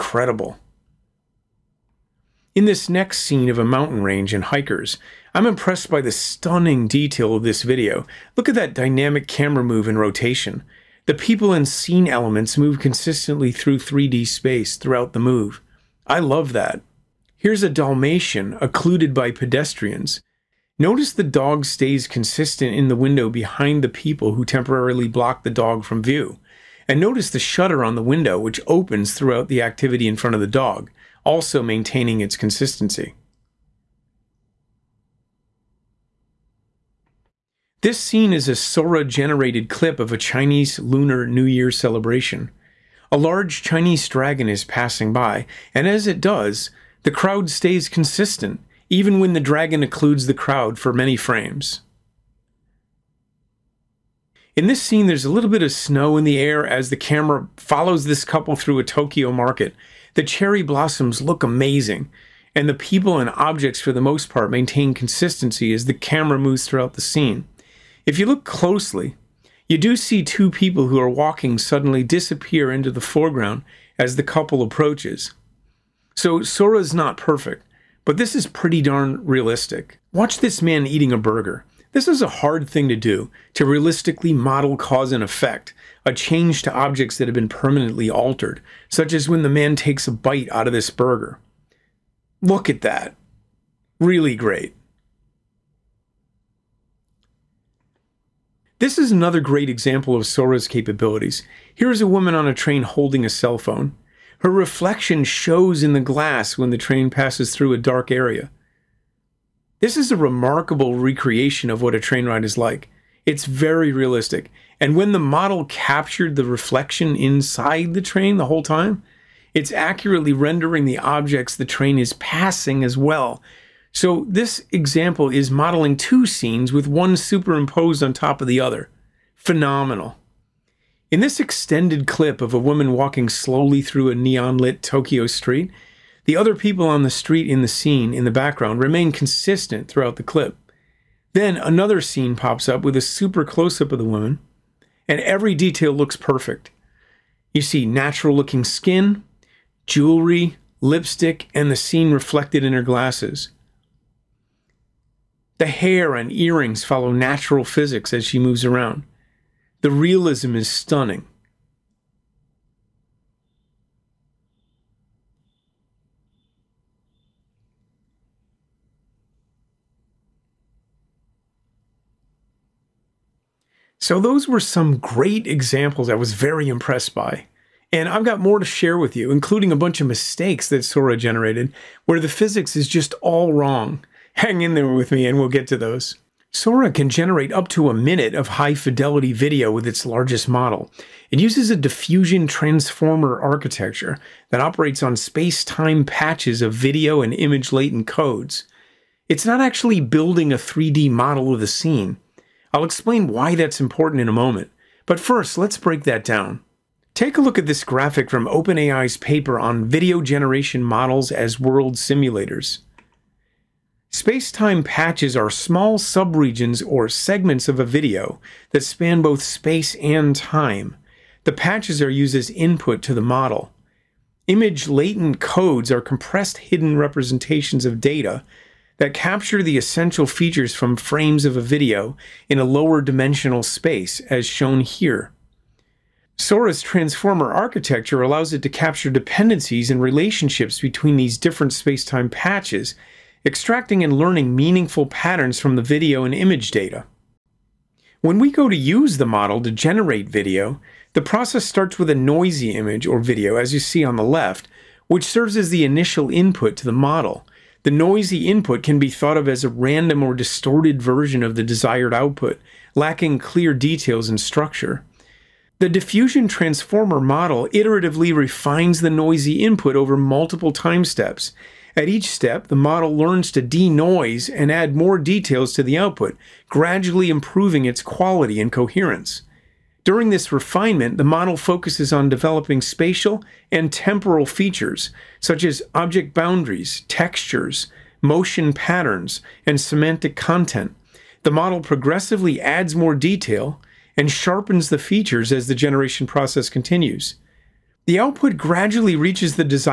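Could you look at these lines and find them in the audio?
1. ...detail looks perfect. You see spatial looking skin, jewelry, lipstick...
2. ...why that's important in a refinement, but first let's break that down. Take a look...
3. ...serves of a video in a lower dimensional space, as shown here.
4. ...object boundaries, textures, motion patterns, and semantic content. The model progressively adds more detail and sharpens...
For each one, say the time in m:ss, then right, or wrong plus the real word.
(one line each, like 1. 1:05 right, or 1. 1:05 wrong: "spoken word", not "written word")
1. 2:25 wrong: "natural", not "spatial"
2. 3:23 wrong: "moment", not "refinement"
3. 3:50 wrong: "frames", not "serves"
4. 4:45 right.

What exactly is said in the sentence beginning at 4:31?
At each step, the model learns to denoise and add more details to the output, gradually improving its quality and coherence.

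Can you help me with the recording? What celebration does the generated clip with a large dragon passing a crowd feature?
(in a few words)
Chinese Lunar New Year.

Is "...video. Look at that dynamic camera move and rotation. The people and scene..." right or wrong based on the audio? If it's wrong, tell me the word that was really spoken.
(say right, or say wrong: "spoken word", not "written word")
right.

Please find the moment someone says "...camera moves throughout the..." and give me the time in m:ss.
1:05.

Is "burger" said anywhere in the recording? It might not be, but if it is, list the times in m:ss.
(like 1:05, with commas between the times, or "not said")
1:21, 1:30.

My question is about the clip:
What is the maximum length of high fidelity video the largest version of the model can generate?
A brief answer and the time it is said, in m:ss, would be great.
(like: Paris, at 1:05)
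A minute, at 3:07.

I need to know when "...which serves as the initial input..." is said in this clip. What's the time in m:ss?
4:15.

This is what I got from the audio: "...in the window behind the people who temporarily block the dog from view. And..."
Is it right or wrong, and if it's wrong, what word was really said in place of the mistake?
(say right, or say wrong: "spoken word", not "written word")
right.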